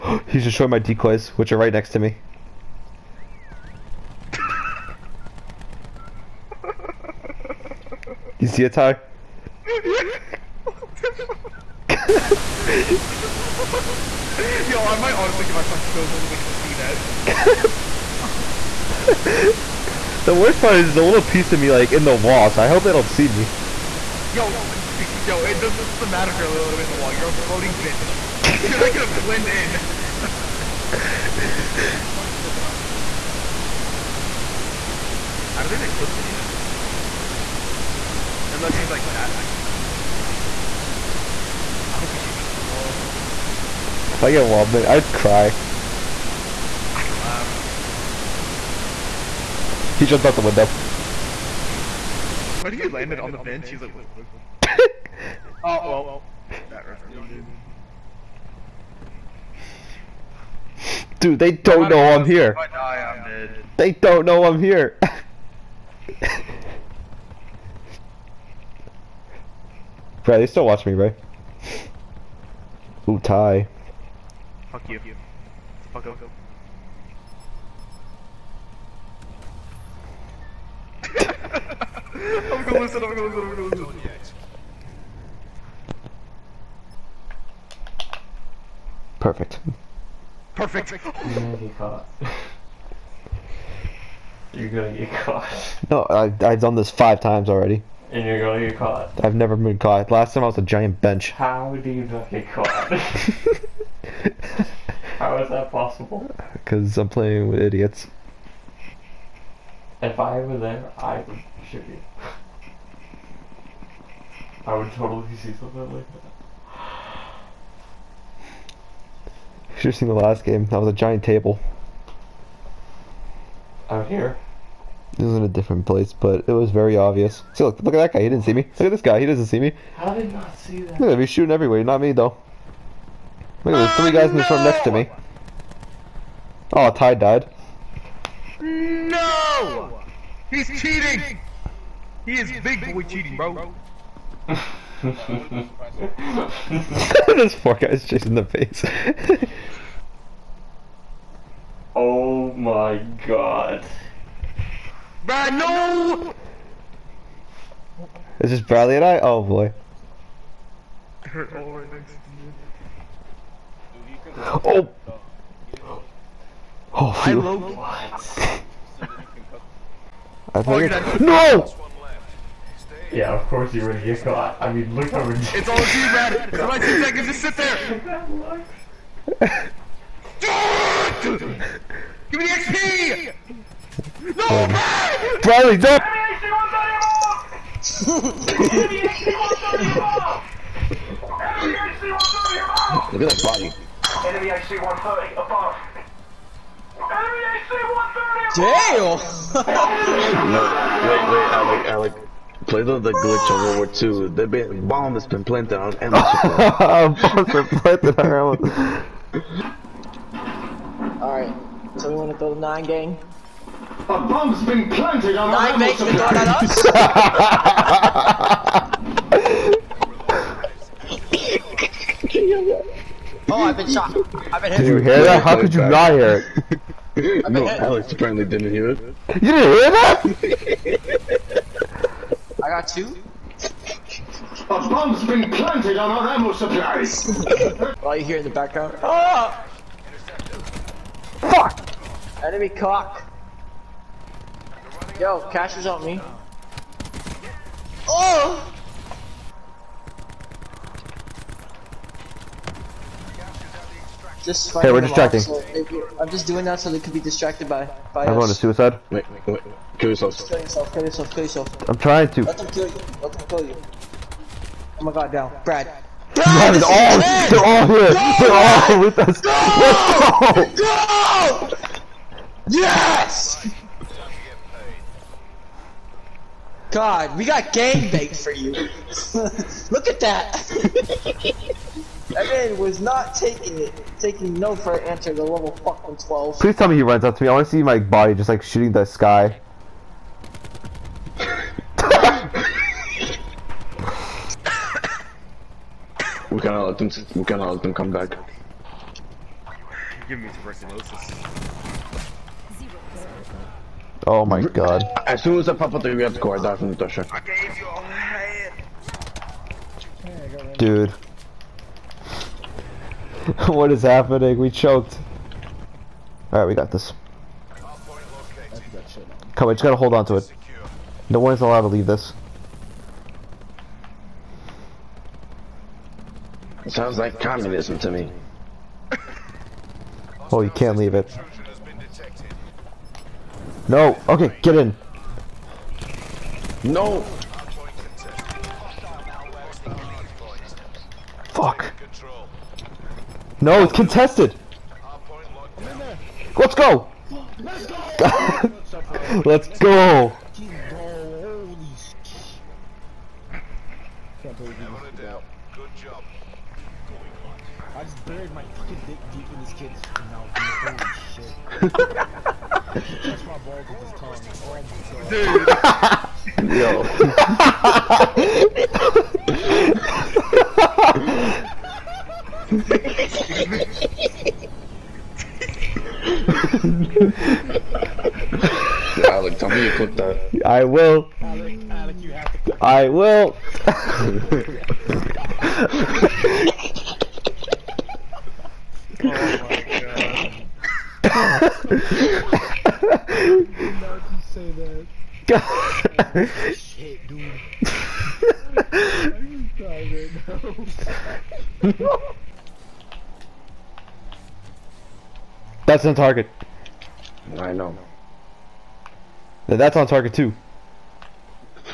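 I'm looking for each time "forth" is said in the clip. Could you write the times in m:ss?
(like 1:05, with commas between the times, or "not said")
not said.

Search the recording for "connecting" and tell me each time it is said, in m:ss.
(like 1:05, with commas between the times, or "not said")
not said.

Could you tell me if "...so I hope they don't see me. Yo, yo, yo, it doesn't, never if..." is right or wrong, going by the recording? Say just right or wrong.
wrong.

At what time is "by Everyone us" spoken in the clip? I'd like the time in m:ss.
4:18.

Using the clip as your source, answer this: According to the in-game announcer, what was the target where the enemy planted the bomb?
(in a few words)
ammo supply.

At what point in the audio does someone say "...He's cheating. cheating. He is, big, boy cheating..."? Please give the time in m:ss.
2:20.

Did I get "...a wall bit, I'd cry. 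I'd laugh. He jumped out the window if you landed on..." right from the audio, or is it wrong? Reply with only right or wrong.
right.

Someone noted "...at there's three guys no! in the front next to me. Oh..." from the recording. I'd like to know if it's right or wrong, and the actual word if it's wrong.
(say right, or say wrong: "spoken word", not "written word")
right.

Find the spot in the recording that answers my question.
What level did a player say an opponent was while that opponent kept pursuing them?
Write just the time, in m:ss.
4:46.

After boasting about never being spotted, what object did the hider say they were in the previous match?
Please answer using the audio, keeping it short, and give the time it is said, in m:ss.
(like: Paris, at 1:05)
giant table, at 2:00.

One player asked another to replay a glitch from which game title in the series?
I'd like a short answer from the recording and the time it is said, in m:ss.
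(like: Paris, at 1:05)
World War Two, at 3:23.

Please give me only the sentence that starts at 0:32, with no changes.
Probably sticking out to the wall too.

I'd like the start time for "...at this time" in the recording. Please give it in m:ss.
6:04.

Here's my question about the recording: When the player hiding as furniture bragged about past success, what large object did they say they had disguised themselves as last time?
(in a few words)
giant bench.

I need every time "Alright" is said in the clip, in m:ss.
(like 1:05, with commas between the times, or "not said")
3:31, 5:16.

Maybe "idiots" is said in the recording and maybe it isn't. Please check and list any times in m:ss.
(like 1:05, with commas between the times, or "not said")
1:47.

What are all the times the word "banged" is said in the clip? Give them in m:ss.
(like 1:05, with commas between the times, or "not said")
4:38.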